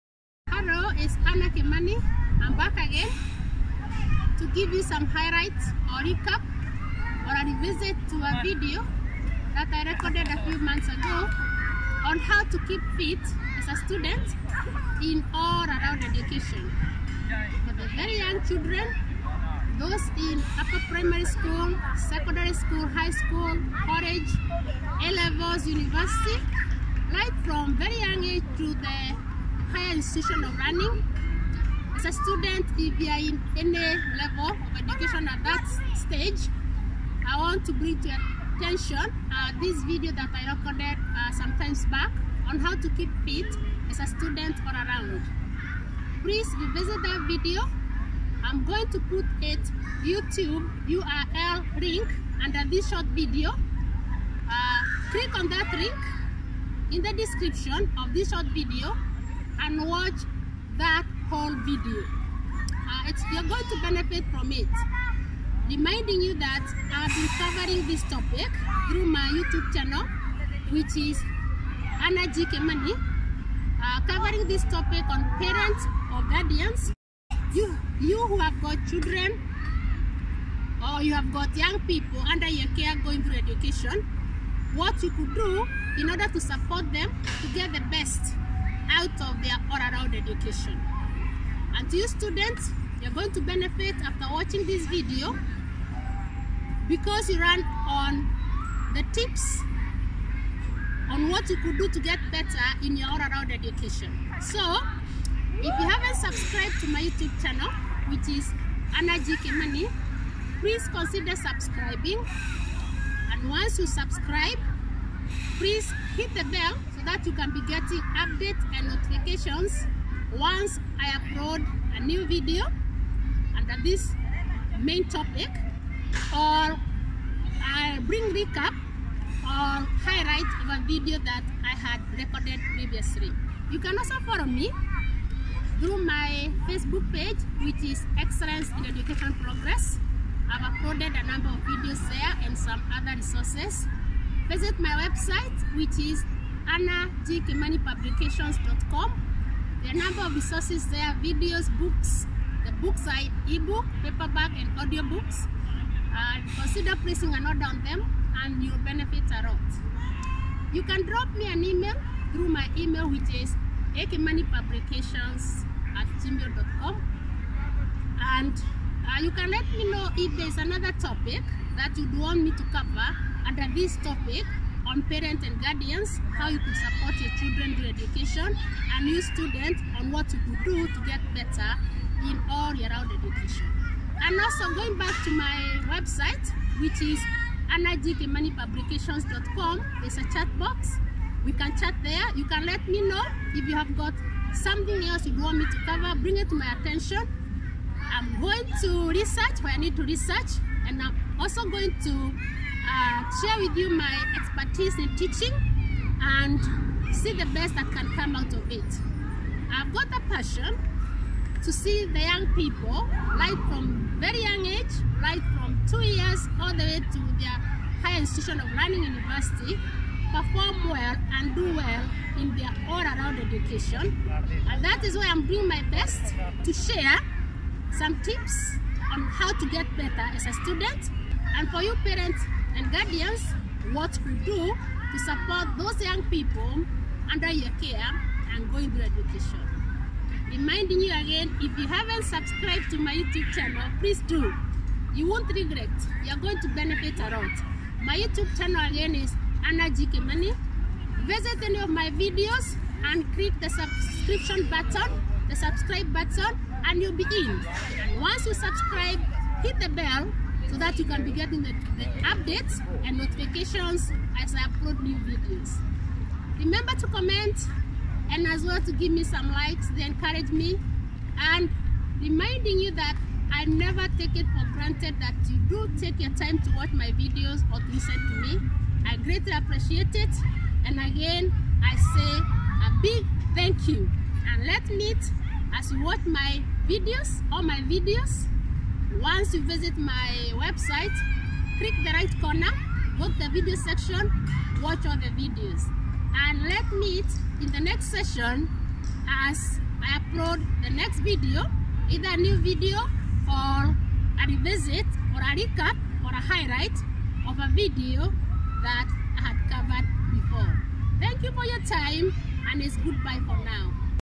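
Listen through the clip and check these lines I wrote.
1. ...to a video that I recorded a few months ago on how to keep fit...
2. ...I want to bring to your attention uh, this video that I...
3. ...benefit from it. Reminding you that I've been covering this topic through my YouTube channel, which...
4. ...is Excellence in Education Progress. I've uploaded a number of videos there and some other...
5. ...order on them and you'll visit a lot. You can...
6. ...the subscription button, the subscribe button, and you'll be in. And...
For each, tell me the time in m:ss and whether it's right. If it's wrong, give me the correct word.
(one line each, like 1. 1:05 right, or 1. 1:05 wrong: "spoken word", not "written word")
1. 0:08 right
2. 0:37 right
3. 1:03 right
4. 2:17 right
5. 2:37 wrong: "benefit", not "visit"
6. 4:13 right.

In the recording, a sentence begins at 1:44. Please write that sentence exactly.
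So, if you haven't subscribed to my YouTube channel, which is Annah G Kimani, please consider subscribing.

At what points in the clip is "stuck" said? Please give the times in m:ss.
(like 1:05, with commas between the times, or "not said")
not said.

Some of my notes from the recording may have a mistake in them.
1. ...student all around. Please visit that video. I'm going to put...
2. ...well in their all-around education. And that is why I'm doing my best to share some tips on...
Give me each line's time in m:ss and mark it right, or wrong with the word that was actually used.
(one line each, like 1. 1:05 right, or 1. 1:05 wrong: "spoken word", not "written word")
1. 0:44 wrong: "revisit", not "visit"
2. 3:41 right.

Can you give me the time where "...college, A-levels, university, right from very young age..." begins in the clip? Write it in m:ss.
0:23.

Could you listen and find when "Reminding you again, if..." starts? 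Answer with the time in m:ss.
4:00.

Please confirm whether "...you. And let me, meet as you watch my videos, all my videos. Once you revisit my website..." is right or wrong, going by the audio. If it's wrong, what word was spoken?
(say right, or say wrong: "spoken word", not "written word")
wrong: "visit", not "revisit".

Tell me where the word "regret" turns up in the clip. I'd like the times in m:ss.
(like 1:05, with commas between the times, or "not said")
4:05.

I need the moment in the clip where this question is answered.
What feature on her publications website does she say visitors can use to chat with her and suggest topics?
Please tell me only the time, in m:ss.
3:10.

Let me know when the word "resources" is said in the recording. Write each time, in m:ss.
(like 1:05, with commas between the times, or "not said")
2:23, 2:30.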